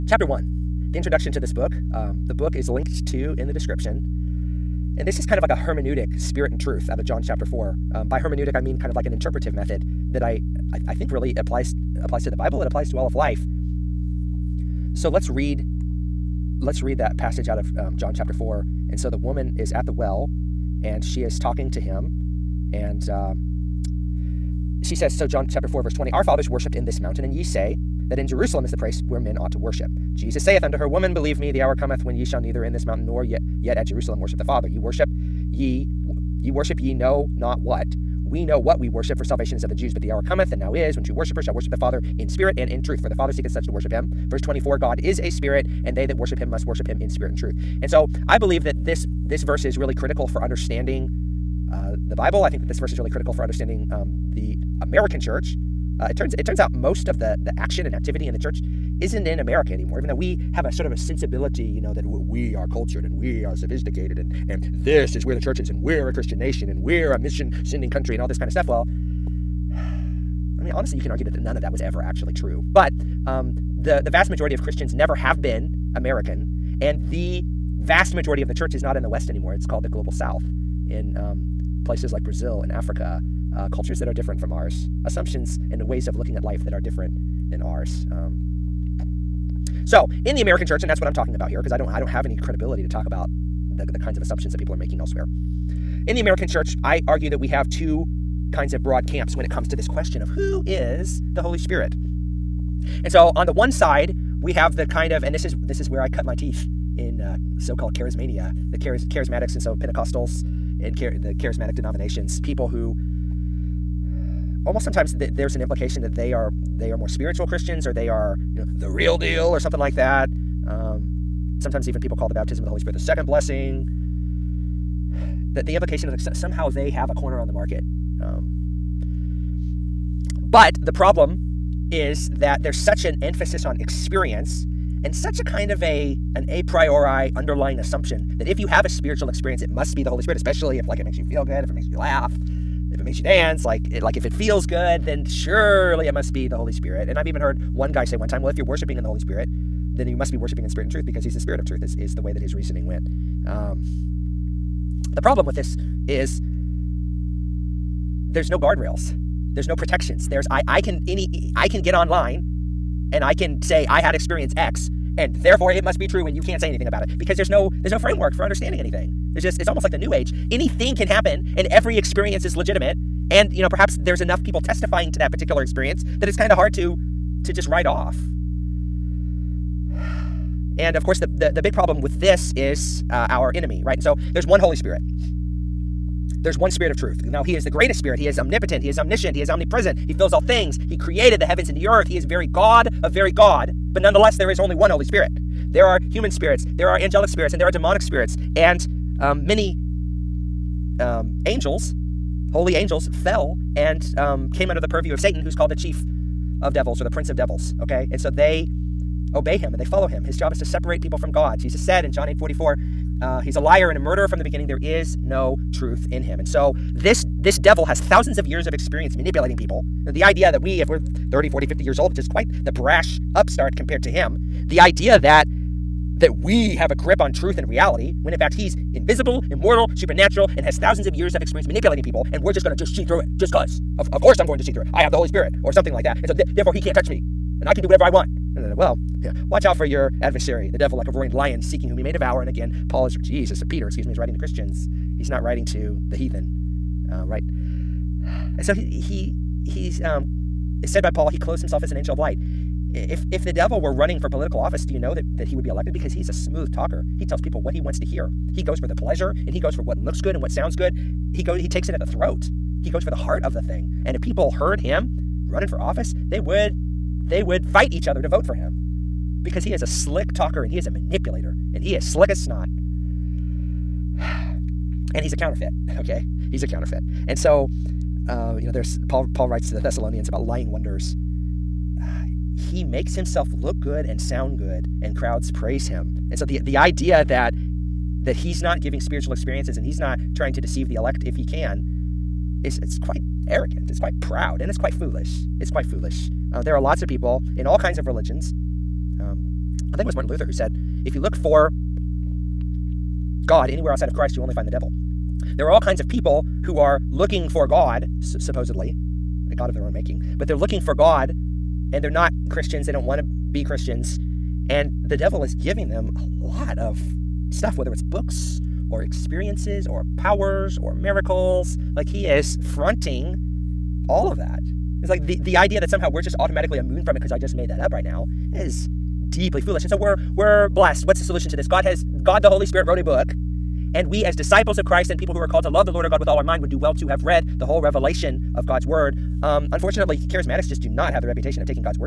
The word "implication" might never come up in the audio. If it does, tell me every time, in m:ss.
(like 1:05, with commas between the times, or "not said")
1:55, 2:05.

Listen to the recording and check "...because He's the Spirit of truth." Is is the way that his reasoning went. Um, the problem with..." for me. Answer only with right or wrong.
right.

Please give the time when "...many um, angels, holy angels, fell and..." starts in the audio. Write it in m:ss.
3:19.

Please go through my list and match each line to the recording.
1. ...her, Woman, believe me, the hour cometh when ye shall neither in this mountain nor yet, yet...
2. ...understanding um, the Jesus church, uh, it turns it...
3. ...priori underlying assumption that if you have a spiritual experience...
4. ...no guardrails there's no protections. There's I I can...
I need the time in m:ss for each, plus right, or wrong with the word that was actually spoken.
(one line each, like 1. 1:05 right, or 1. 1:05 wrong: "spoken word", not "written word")
1. 0:30 right
2. 0:53 wrong: "American", not "Jesus"
3. 2:16 right
4. 2:38 right.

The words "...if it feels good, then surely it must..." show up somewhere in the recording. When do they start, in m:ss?
2:24.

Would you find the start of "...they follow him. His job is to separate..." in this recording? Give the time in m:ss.
3:29.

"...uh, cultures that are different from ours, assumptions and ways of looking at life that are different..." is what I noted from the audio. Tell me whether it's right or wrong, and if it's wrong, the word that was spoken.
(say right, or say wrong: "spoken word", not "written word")
right.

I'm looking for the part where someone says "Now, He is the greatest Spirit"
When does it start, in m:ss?
3:07.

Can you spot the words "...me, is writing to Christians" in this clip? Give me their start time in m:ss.
4:04.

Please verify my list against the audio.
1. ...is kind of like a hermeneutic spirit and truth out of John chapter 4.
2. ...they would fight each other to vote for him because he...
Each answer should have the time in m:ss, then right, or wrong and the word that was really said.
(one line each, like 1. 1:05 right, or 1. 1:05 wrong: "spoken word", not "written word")
1. 0:05 right
2. 4:27 right.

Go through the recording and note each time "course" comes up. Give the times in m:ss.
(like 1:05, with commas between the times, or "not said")
3:01, 3:54.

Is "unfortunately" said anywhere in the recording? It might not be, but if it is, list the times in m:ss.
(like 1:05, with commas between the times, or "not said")
5:39.